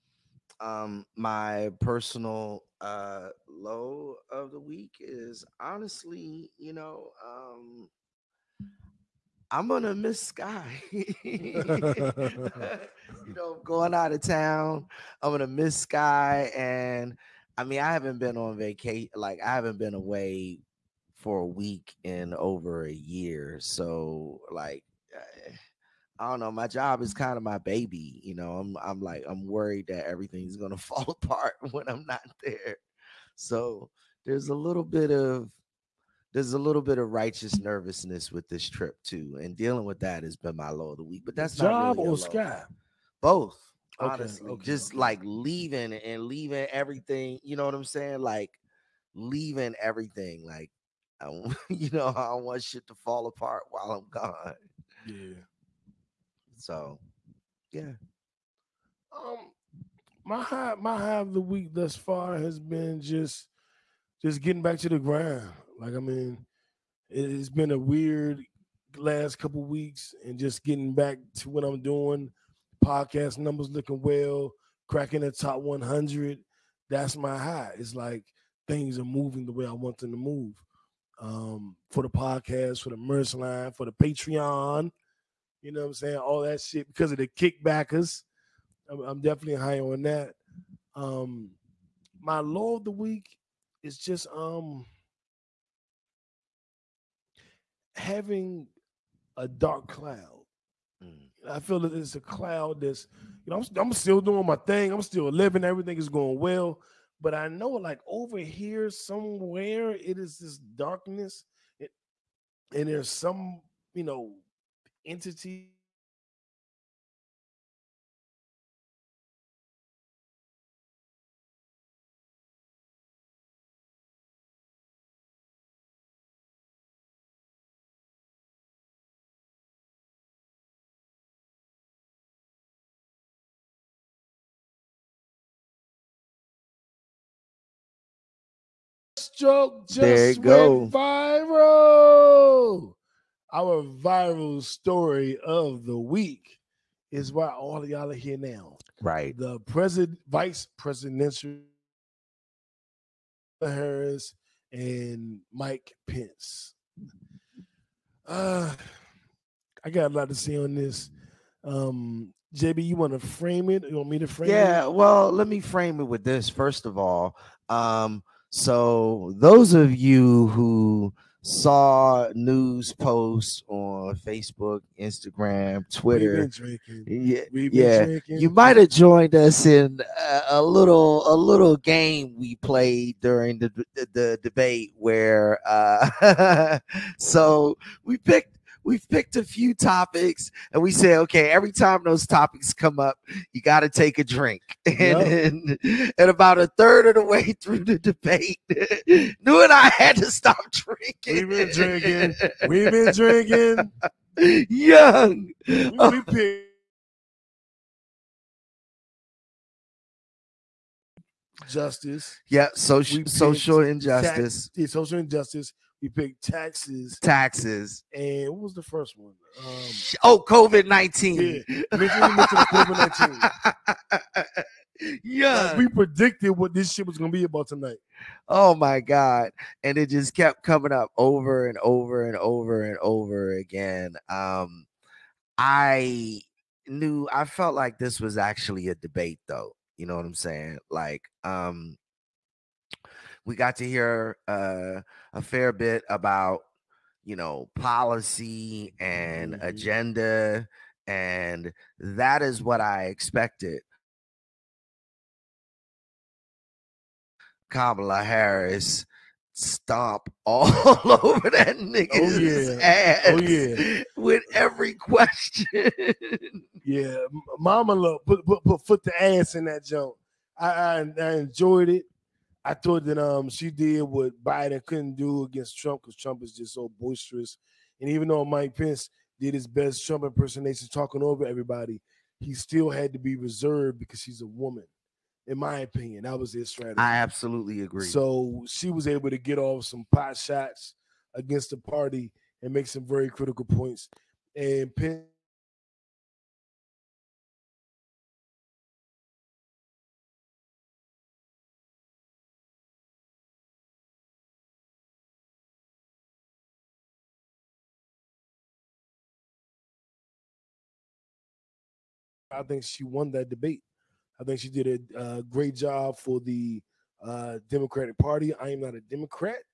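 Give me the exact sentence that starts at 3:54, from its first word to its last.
Um, I knew, I felt like this was actually a debate though.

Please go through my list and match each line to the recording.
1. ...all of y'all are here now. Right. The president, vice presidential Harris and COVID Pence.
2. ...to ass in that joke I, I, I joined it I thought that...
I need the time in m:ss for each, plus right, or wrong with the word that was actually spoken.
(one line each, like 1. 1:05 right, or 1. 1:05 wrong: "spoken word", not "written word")
1. 2:27 wrong: "Mike", not "COVID"
2. 4:29 wrong: "enjoyed", not "joined".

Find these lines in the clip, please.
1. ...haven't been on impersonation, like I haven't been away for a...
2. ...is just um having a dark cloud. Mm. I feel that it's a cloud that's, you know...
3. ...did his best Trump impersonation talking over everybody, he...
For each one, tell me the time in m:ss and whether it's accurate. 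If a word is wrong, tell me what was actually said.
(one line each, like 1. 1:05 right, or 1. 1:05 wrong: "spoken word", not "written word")
1. 0:17 wrong: "vacation", not "impersonation"
2. 1:33 right
3. 4:39 right.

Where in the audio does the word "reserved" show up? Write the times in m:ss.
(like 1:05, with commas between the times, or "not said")
4:43.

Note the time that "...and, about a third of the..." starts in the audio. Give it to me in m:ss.
3:16.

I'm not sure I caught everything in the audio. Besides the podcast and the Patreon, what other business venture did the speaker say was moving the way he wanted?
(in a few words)
Merch line.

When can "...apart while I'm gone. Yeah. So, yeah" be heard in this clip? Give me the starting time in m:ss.
0:53.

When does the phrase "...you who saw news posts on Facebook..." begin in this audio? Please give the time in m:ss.
2:49.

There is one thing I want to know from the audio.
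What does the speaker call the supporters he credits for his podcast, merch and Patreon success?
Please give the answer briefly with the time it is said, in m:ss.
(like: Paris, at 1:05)
The kickbackers, at 1:27.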